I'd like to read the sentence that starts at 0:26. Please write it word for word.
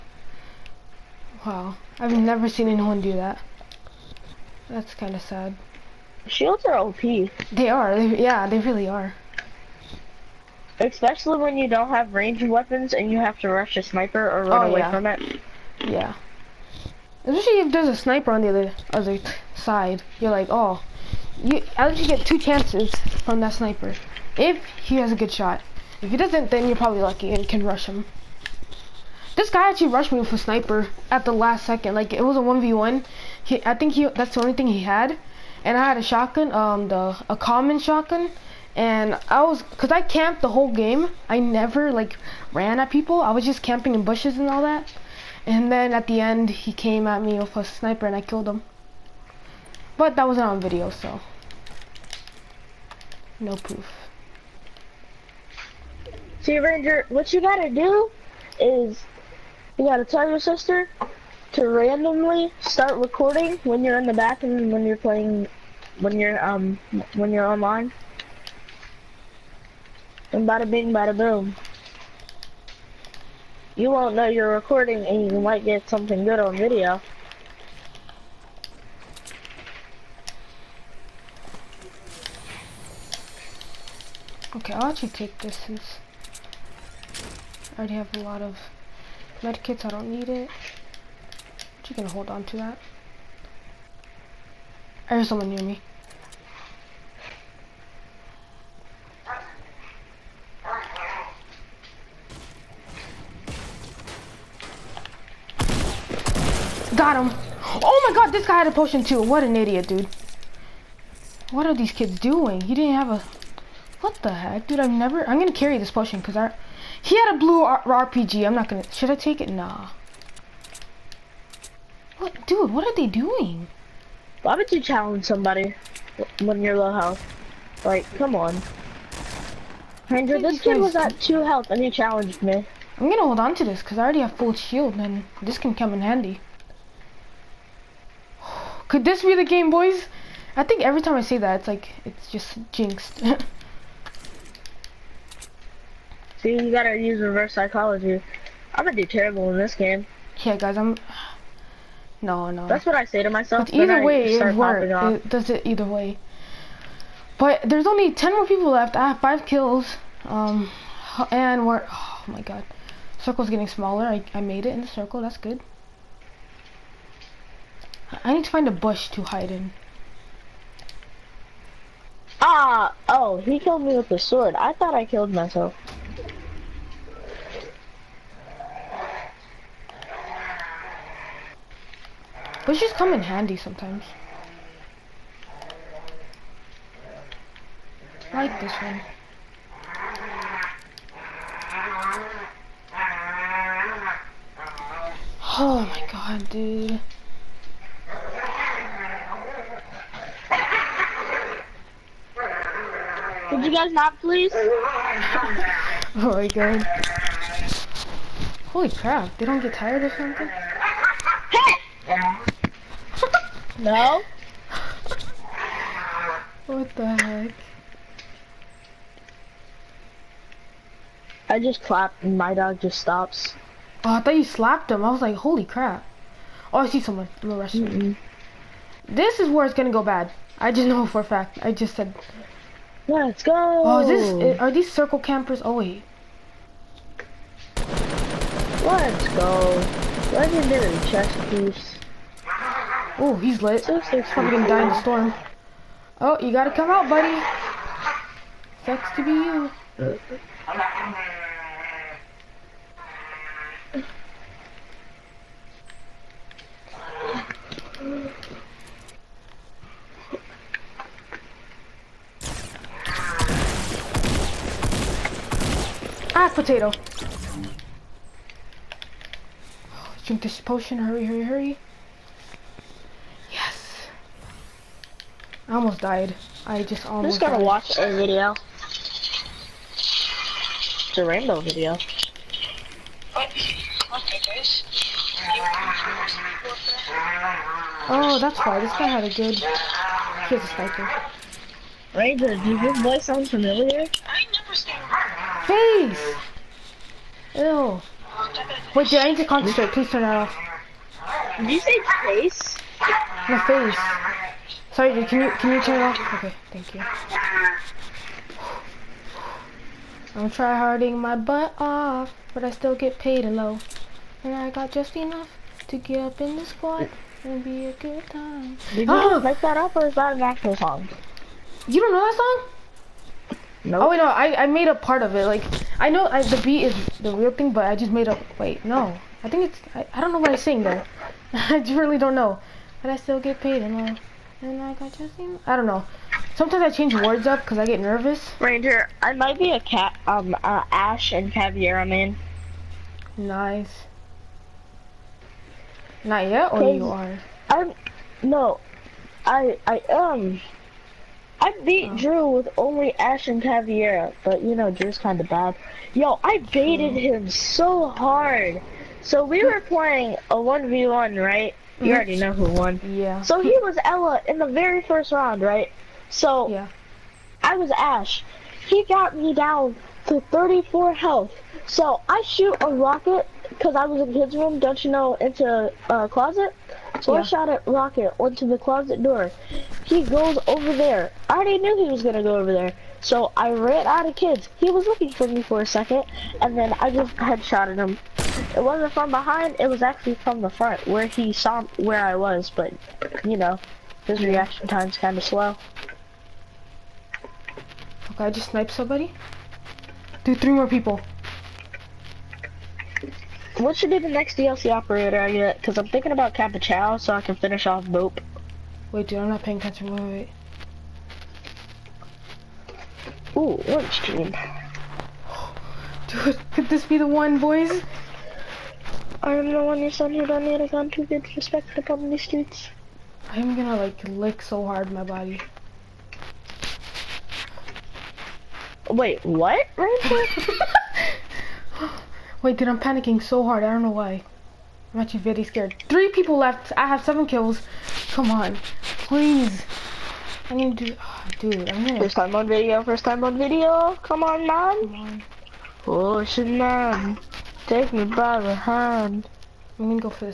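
If he doesn't, then you're probably lucky and can rush him.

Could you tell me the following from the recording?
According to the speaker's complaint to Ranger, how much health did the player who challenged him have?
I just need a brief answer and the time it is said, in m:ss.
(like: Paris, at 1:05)
2, at 2:11.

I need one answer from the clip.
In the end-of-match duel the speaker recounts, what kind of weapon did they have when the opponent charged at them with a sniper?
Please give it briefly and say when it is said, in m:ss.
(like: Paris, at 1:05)
common shotgun, at 0:37.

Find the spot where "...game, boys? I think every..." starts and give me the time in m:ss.
2:19.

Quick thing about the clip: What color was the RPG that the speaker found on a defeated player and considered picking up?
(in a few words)
blue.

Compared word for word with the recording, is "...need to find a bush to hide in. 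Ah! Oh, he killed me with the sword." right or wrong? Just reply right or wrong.
right.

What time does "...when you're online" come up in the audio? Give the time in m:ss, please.
1:07.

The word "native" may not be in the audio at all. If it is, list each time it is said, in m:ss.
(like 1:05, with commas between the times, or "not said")
not said.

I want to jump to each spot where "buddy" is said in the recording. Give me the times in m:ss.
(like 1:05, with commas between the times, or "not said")
4:07.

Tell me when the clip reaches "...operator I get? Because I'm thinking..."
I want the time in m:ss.
6:44.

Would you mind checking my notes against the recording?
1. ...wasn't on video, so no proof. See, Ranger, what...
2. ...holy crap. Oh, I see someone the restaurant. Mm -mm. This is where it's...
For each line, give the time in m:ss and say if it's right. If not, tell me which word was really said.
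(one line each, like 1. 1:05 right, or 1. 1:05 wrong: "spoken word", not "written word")
1. 0:50 right
2. 3:45 right.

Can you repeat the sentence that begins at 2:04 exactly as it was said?
Why would you challenge somebody when you're low health?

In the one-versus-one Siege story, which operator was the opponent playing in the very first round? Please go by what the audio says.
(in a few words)
Ela.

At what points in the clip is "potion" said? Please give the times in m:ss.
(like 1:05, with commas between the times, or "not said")
1:48, 1:55, 4:30.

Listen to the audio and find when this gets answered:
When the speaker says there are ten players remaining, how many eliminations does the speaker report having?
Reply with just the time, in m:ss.
2:39.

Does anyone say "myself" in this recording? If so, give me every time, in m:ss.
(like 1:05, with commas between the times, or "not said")
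2:33, 2:55.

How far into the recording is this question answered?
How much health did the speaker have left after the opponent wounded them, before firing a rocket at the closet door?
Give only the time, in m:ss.
6:10.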